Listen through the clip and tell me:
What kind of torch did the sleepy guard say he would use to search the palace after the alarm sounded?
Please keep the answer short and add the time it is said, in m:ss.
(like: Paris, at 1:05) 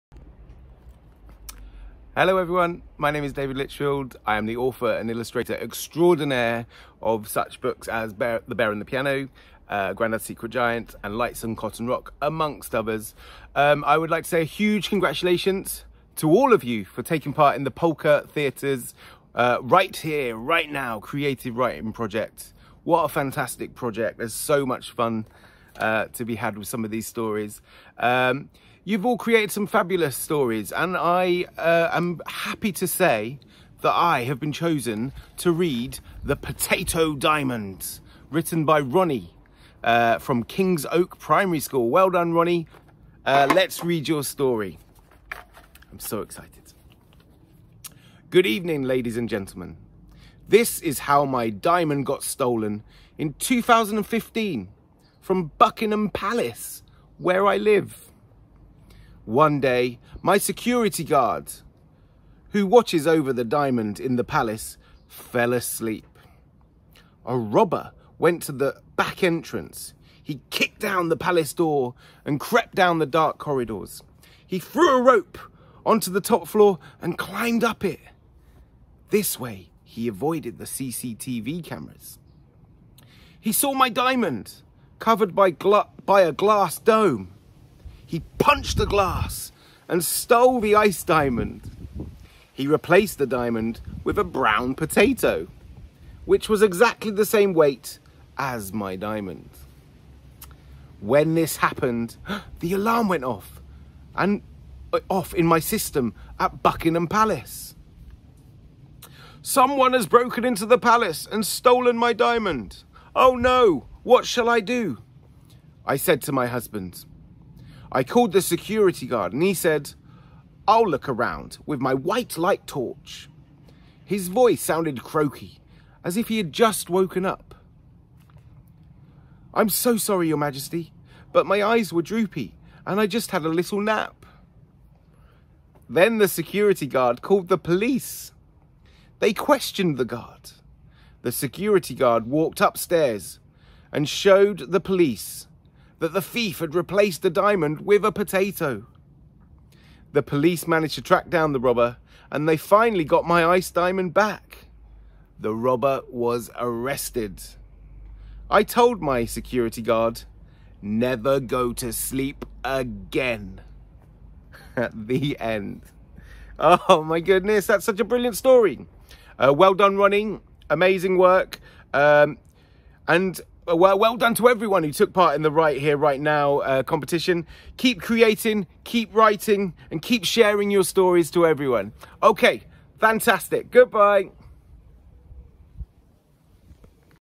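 White light torch, at 2:01.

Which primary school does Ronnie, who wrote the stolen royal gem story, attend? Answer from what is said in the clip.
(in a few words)
Kings Oak Primary School.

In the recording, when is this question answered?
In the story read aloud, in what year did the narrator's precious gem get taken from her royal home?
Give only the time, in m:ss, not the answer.
0:53.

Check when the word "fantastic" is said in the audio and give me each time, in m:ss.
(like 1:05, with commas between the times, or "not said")
0:23, 3:02.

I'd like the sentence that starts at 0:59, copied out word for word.
One day, my security guard, who watches over the diamond in the palace, fell asleep.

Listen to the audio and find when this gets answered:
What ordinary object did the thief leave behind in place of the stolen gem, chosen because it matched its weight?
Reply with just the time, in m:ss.
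1:34.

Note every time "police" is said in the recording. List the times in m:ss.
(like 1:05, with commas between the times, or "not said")
2:17, 2:24, 2:30.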